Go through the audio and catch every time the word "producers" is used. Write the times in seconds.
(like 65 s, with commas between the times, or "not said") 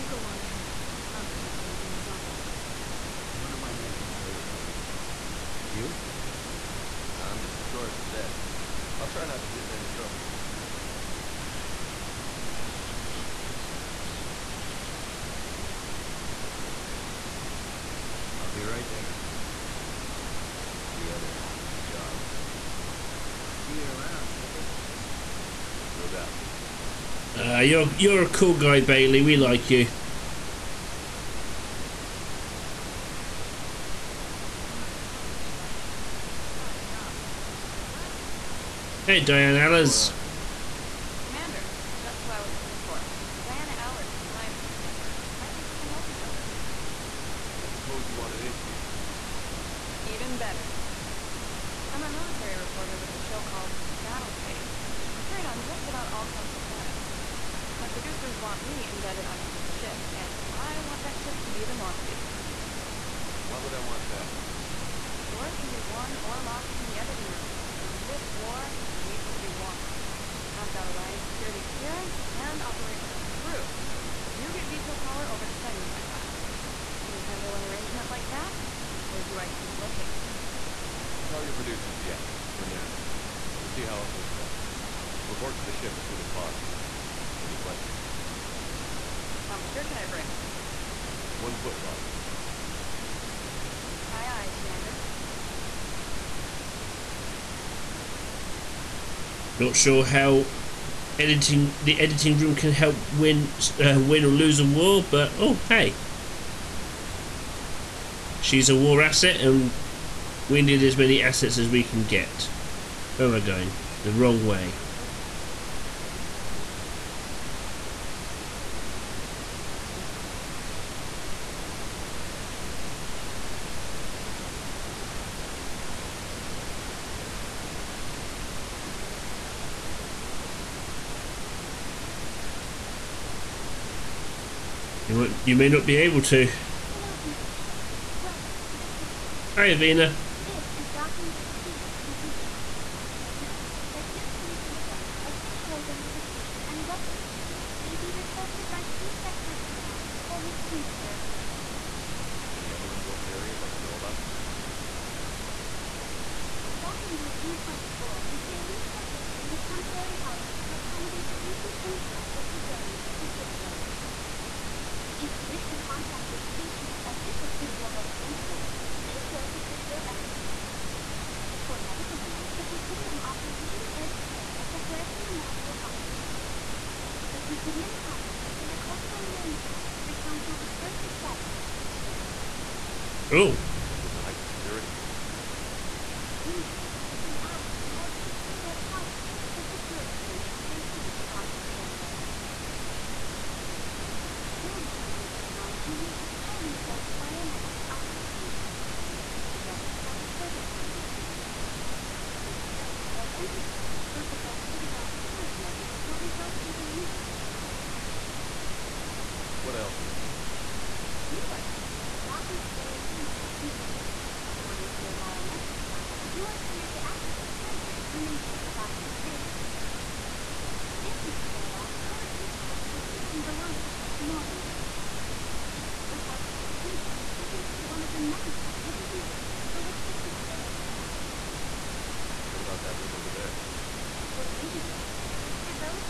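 57 s, 81 s.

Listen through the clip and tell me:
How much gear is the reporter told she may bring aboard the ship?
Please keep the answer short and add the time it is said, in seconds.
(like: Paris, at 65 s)
One foot locker, at 91 s.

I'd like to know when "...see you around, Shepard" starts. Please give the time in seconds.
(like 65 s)
23 s.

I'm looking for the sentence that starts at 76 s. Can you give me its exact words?
Can you handle an arrangement like that?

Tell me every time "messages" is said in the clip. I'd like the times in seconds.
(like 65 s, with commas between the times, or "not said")
114 s, 122 s.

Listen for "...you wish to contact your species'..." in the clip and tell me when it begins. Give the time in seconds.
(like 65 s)
165 s.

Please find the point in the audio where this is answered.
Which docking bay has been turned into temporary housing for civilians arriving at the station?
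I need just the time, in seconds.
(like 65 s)
156 s.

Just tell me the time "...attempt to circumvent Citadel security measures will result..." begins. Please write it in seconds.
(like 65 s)
203 s.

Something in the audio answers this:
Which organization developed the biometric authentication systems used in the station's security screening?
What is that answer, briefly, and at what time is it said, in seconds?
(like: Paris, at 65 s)
Sirta Foundation, at 200 s.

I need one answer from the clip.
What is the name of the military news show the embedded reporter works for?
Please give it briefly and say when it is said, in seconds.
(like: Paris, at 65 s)
Battle Space, at 54 s.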